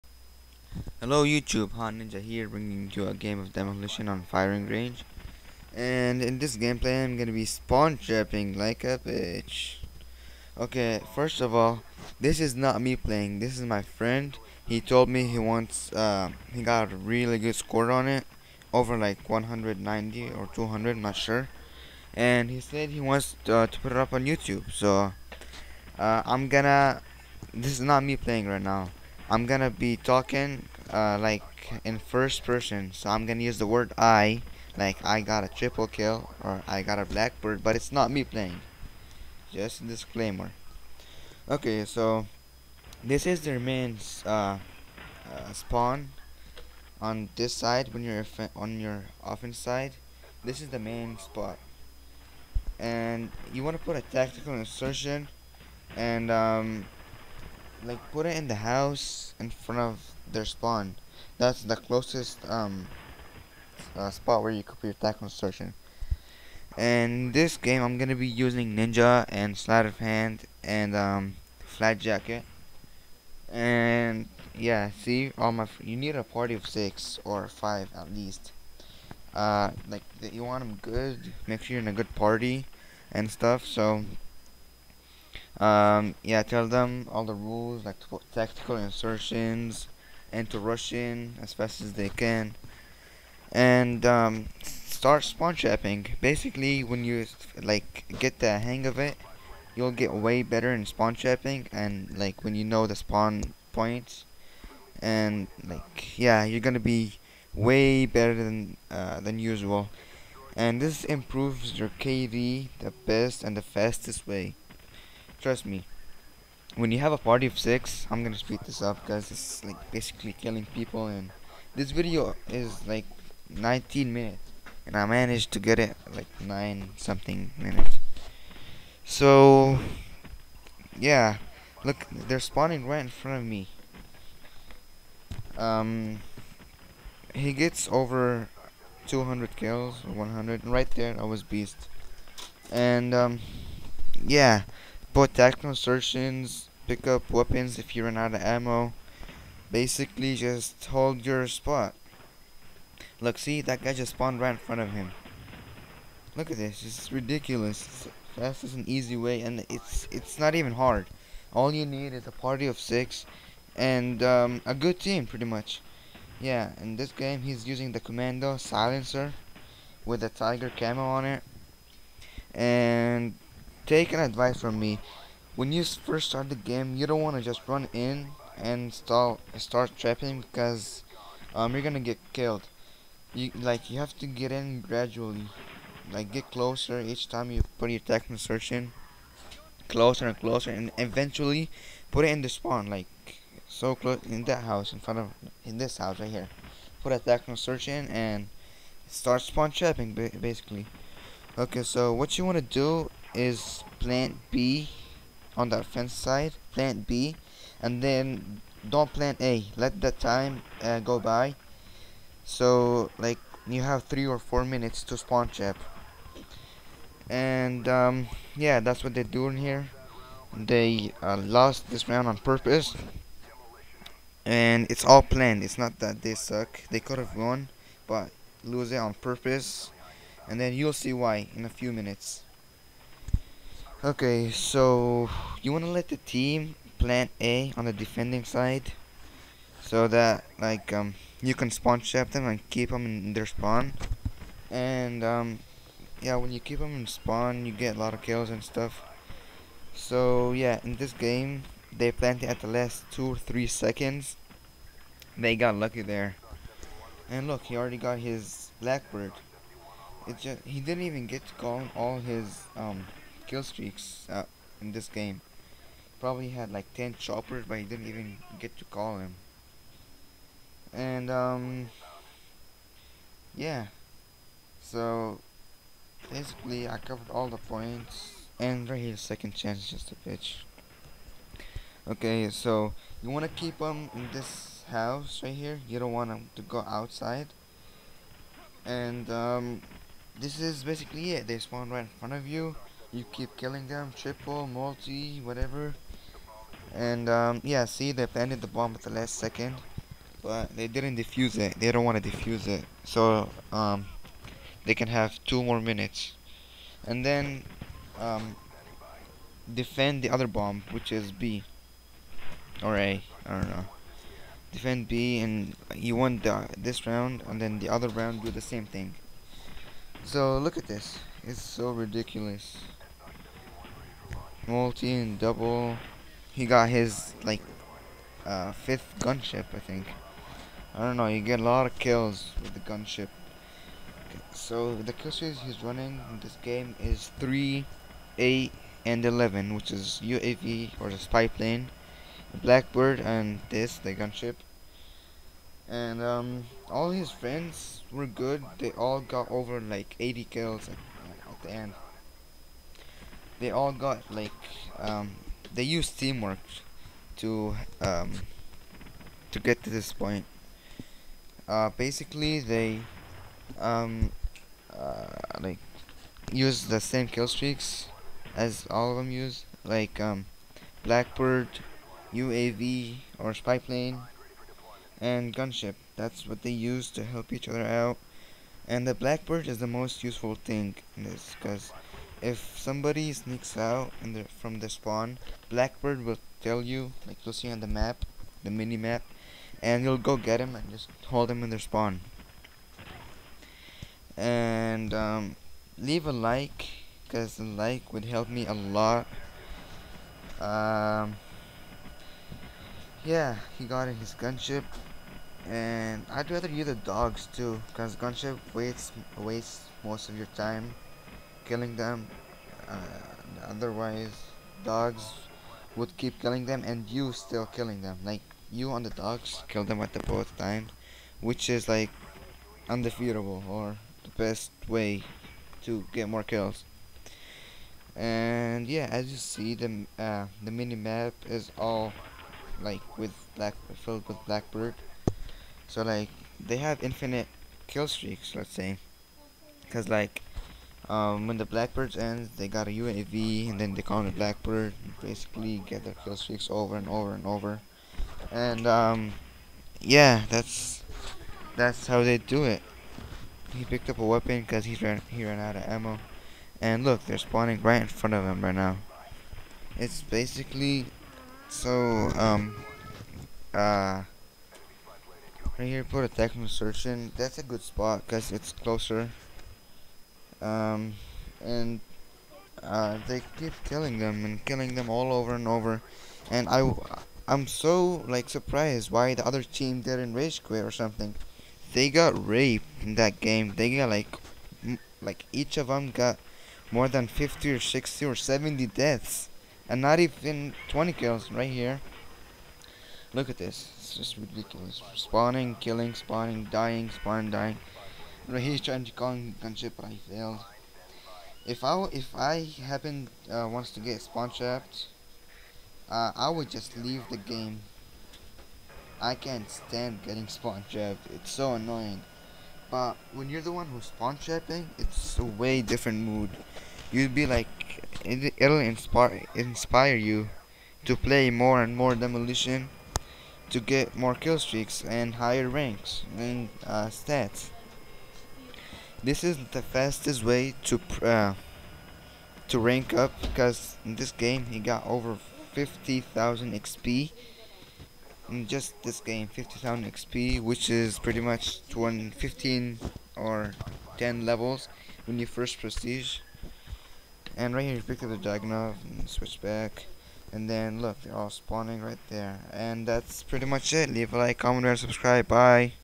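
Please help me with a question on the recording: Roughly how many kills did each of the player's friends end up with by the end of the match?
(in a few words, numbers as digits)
Over 80.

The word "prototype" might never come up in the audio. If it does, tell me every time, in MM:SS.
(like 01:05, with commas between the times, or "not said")
not said.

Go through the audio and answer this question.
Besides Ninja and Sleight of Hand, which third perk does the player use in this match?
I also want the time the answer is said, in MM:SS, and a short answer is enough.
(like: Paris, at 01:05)
Flat Jacket, at 01:11.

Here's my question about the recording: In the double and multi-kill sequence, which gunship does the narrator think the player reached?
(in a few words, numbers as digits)
Fifth.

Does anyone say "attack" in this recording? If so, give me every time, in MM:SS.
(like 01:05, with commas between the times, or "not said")
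03:07, 03:17.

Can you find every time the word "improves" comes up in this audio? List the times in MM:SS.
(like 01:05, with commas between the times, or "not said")
01:51.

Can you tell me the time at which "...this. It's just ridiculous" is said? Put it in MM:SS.
08:13.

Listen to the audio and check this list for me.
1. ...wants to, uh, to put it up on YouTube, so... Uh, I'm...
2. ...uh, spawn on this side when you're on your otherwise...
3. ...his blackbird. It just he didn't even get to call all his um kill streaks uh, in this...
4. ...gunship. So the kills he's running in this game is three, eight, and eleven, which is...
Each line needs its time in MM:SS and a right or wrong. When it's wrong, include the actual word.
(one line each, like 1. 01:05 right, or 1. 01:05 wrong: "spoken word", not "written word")
1. 00:23 right
2. 00:45 wrong: "offense", not "otherwise"
3. 04:18 right
4. 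05:32 right.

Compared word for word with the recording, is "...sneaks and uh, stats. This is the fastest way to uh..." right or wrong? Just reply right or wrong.
wrong.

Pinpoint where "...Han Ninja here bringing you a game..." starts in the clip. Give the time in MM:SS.
00:01.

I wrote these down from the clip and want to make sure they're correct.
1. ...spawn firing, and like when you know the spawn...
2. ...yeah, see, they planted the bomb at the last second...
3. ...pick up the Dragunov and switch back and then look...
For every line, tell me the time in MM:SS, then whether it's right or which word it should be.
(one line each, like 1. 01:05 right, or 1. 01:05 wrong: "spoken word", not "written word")
1. 01:40 wrong: "trapping", not "firing"
2. 04:57 right
3. 09:08 right.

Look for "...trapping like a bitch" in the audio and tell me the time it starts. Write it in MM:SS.
00:07.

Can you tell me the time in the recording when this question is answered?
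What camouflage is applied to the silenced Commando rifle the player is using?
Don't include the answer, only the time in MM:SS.
02:50.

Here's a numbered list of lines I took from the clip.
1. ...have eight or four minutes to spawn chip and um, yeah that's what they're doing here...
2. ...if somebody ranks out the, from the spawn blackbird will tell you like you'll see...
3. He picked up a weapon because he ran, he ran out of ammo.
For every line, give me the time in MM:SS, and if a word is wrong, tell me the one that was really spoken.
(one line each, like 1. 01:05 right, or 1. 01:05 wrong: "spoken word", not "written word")
1. 03:33 wrong: "three", not "eight"
2. 06:22 wrong: "sneaks", not "ranks"
3. 07:33 right.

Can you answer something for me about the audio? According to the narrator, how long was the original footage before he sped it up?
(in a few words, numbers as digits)
19 minutes.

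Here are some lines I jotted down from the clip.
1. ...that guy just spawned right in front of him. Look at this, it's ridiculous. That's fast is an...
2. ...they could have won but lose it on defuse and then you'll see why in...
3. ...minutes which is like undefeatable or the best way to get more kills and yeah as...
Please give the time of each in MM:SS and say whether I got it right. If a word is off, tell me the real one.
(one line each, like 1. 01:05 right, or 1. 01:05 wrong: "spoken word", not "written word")
1. 02:33 right
2. 03:46 wrong: "purpose", not "defuse"
3. 07:00 wrong: "times", not "minutes".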